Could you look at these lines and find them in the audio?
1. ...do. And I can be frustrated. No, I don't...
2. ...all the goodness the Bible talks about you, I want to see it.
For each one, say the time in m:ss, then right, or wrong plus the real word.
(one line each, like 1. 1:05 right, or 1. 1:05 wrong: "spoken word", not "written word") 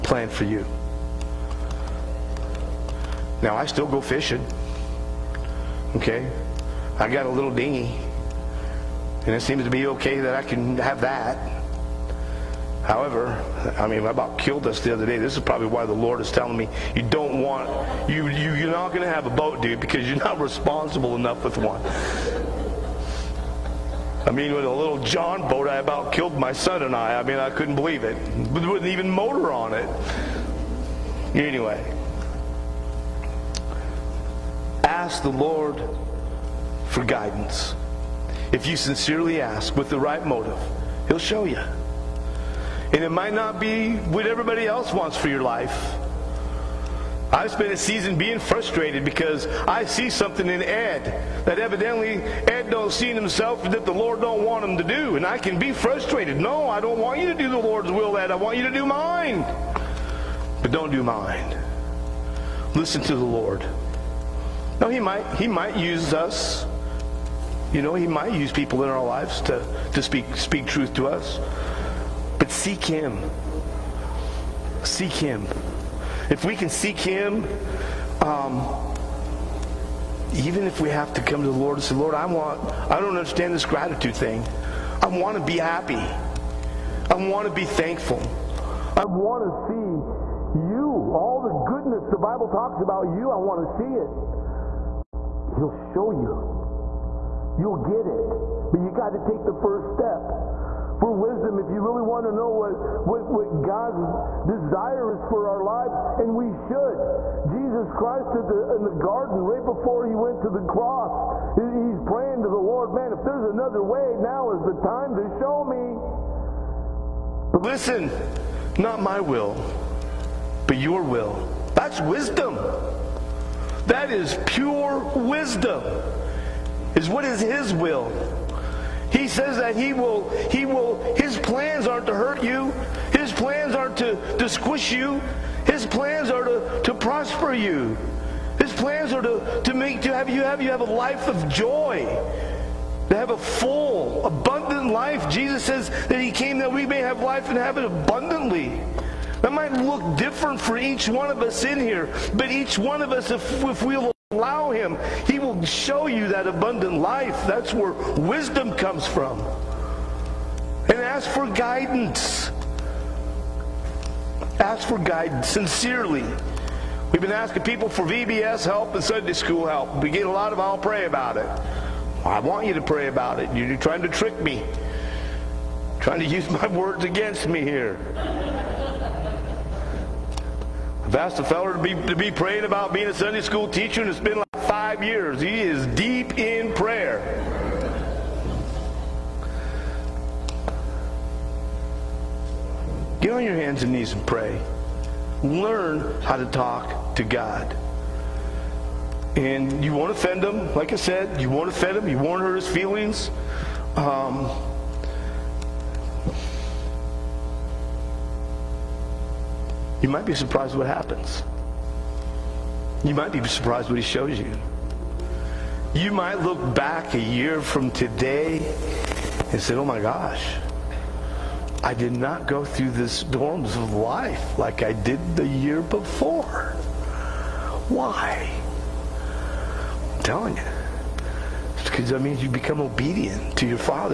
1. 0:54 right
2. 1:31 right.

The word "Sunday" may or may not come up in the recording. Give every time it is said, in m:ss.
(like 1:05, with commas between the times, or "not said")
2:49, 3:03.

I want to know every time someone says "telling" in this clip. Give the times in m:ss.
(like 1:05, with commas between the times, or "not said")
0:16, 3:50.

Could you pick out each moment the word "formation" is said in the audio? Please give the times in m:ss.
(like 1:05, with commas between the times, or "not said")
not said.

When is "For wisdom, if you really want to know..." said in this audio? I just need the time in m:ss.
1:40.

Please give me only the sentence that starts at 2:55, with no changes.
Trying to use my words against me here.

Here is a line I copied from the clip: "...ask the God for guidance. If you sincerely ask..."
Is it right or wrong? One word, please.
wrong.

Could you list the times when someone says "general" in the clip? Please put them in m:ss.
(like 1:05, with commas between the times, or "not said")
not said.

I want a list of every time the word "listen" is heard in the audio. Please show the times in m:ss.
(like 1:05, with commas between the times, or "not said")
1:02, 1:57.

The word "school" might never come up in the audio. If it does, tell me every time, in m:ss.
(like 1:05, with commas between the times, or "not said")
2:49, 3:03.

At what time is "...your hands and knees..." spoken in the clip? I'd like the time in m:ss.
3:13.